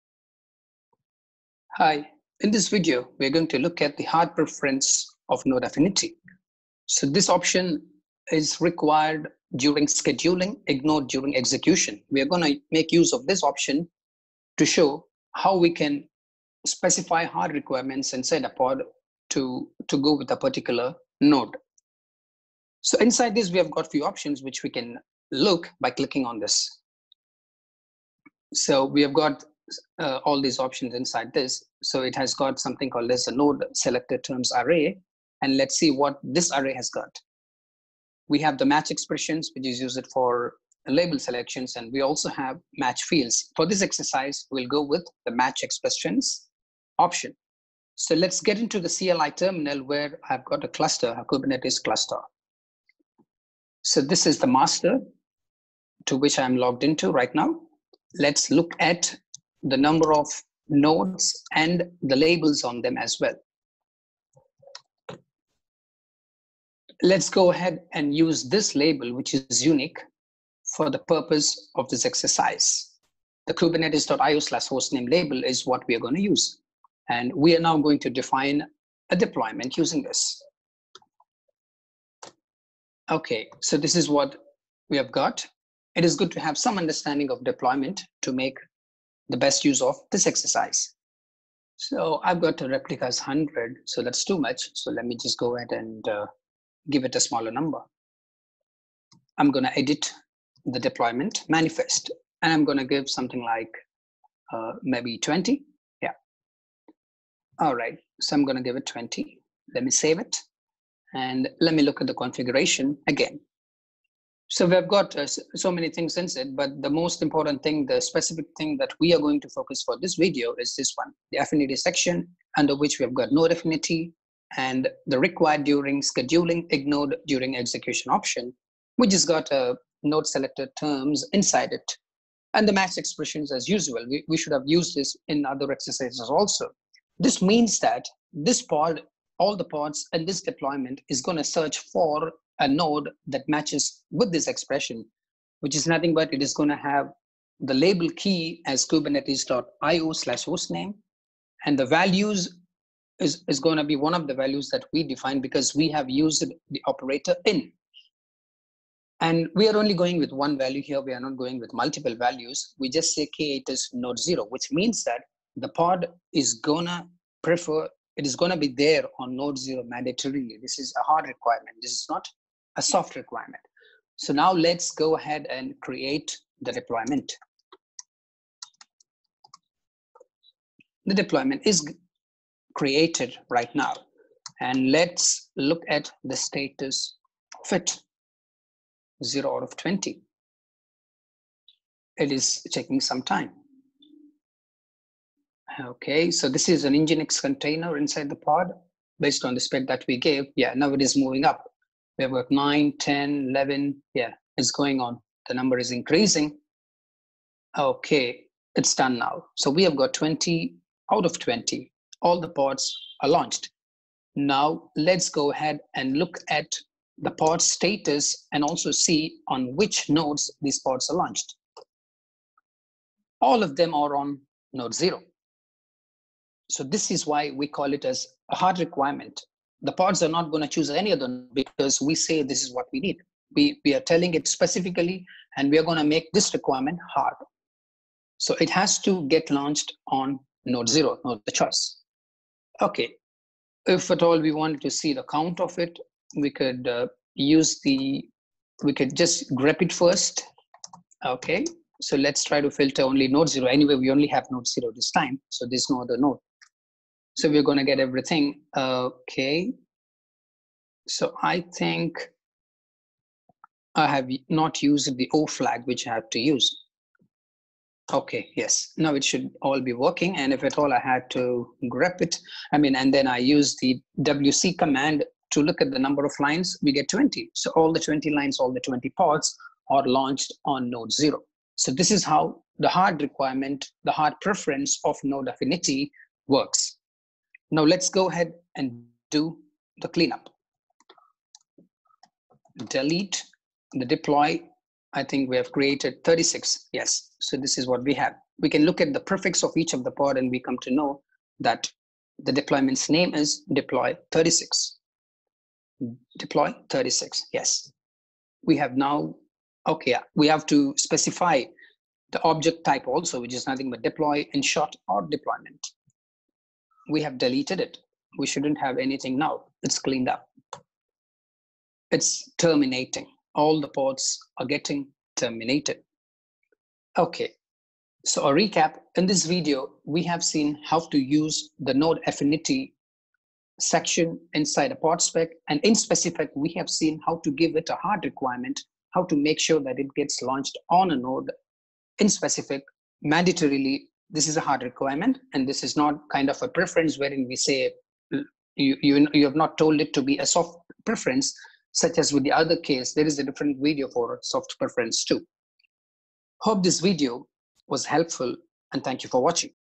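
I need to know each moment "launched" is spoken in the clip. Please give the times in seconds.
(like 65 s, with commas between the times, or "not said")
213 s, 221 s, 239 s, 280 s, 340 s.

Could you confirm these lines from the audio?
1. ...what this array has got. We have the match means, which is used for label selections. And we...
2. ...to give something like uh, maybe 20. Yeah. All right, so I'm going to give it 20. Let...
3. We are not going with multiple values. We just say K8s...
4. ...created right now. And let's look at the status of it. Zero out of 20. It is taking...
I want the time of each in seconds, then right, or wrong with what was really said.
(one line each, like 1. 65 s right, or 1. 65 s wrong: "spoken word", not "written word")
1. 35 s wrong: "expressions", not "means"
2. 102 s right
3. 161 s right
4. 182 s right.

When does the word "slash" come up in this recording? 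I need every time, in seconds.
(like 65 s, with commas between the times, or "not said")
74 s, 150 s.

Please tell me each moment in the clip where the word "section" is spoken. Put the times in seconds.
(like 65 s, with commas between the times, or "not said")
121 s, 333 s.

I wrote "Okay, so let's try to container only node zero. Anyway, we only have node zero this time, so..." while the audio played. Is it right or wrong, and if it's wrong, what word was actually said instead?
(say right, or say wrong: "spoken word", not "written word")
wrong: "filter", not "container".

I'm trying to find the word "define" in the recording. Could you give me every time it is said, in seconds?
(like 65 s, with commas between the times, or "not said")
78 s, 155 s.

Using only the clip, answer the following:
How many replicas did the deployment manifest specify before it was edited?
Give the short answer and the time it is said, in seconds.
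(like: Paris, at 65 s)
100, at 92 s.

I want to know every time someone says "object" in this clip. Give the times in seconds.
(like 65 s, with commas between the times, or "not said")
312 s.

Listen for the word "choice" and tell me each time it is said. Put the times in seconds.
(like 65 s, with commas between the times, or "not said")
241 s.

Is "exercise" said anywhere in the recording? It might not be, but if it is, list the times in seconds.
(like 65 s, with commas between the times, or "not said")
43 s, 72 s, 90 s, 135 s.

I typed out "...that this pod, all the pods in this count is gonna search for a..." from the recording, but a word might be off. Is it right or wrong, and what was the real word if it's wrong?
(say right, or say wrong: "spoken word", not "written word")
wrong: "deployment", not "count".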